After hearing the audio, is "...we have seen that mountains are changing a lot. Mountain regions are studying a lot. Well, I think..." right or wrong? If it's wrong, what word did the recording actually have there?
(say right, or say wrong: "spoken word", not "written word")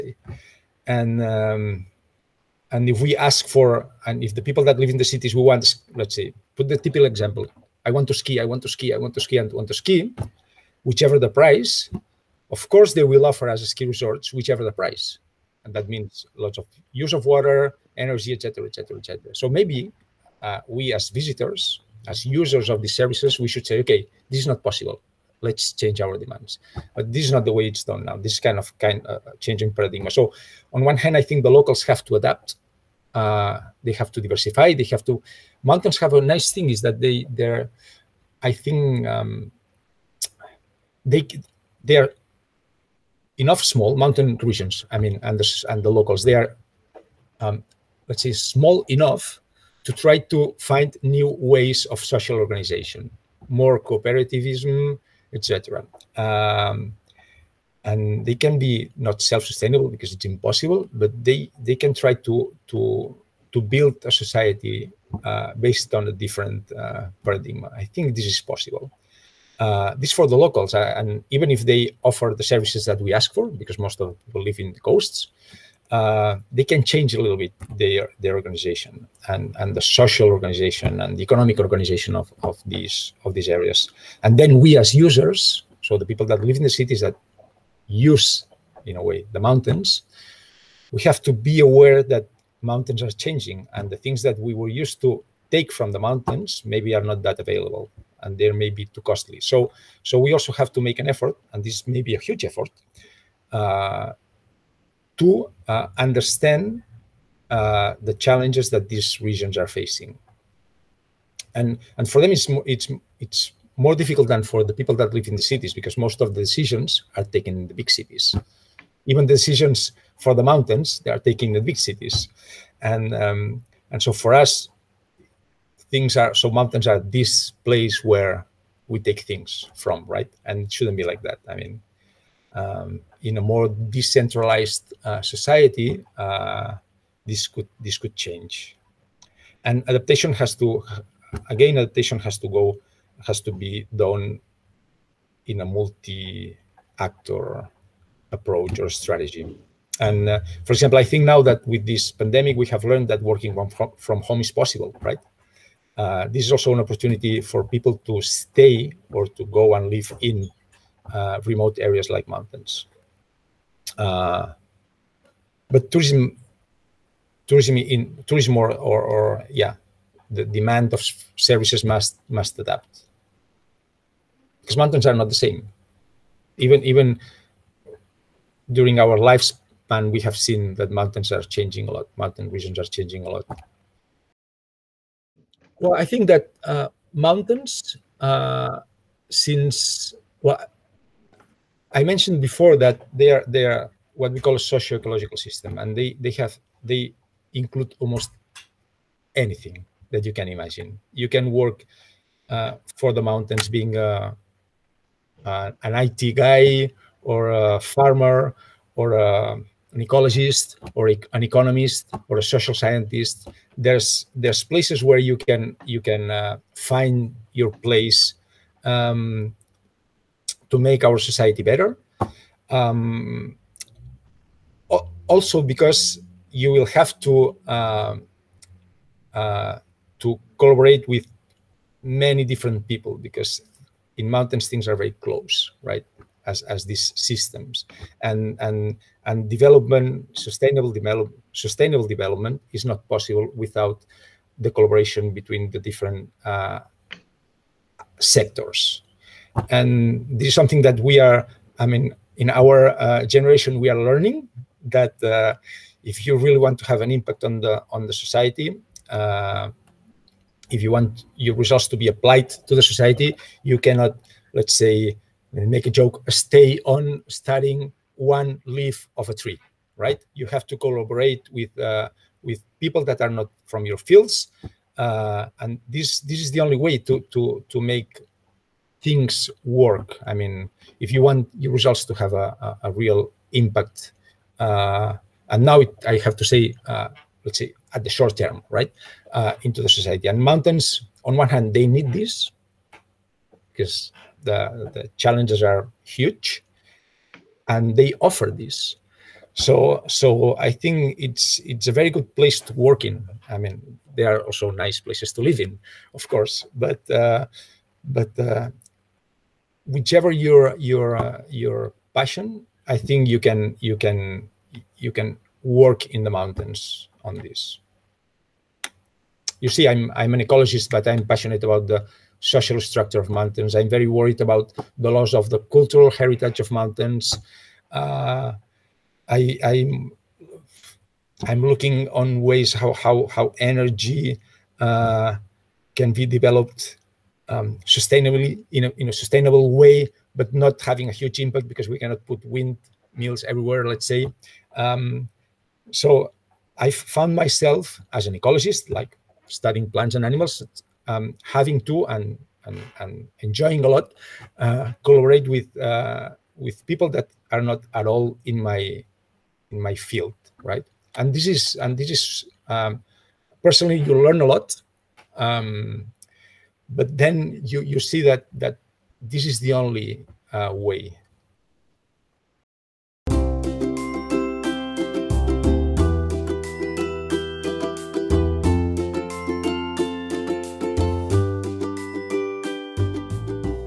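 wrong: "changing", not "studying".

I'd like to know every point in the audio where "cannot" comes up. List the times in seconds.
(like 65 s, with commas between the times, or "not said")
263 s, 341 s.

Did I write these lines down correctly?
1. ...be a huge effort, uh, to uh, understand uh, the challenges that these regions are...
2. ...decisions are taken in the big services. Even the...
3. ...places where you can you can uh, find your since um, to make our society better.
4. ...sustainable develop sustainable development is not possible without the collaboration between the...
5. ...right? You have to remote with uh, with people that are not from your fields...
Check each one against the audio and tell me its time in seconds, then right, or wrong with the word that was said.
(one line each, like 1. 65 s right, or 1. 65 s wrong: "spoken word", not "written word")
1. 102 s right
2. 116 s wrong: "cities", not "services"
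3. 214 s wrong: "place", not "since"
4. 240 s right
5. 269 s wrong: "collaborate", not "remote".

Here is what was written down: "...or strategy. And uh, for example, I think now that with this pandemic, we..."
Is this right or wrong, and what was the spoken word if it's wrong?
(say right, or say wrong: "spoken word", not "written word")
right.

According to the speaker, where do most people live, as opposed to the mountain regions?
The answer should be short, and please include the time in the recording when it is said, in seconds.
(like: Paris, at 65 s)
The coasts, at 74 s.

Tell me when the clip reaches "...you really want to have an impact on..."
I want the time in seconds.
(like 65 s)
256 s.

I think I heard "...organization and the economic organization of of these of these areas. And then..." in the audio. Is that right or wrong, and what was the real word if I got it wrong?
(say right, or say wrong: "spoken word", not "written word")
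right.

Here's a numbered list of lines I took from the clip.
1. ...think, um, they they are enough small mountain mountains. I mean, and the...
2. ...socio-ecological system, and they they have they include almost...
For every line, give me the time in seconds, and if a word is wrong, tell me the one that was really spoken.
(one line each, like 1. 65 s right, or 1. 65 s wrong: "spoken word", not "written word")
1. 38 s wrong: "regions", not "mountains"
2. 194 s right.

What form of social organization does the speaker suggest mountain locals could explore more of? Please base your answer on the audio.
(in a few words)
Cooperativism.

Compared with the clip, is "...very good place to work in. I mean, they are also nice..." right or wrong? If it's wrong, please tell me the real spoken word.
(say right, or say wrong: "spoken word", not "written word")
right.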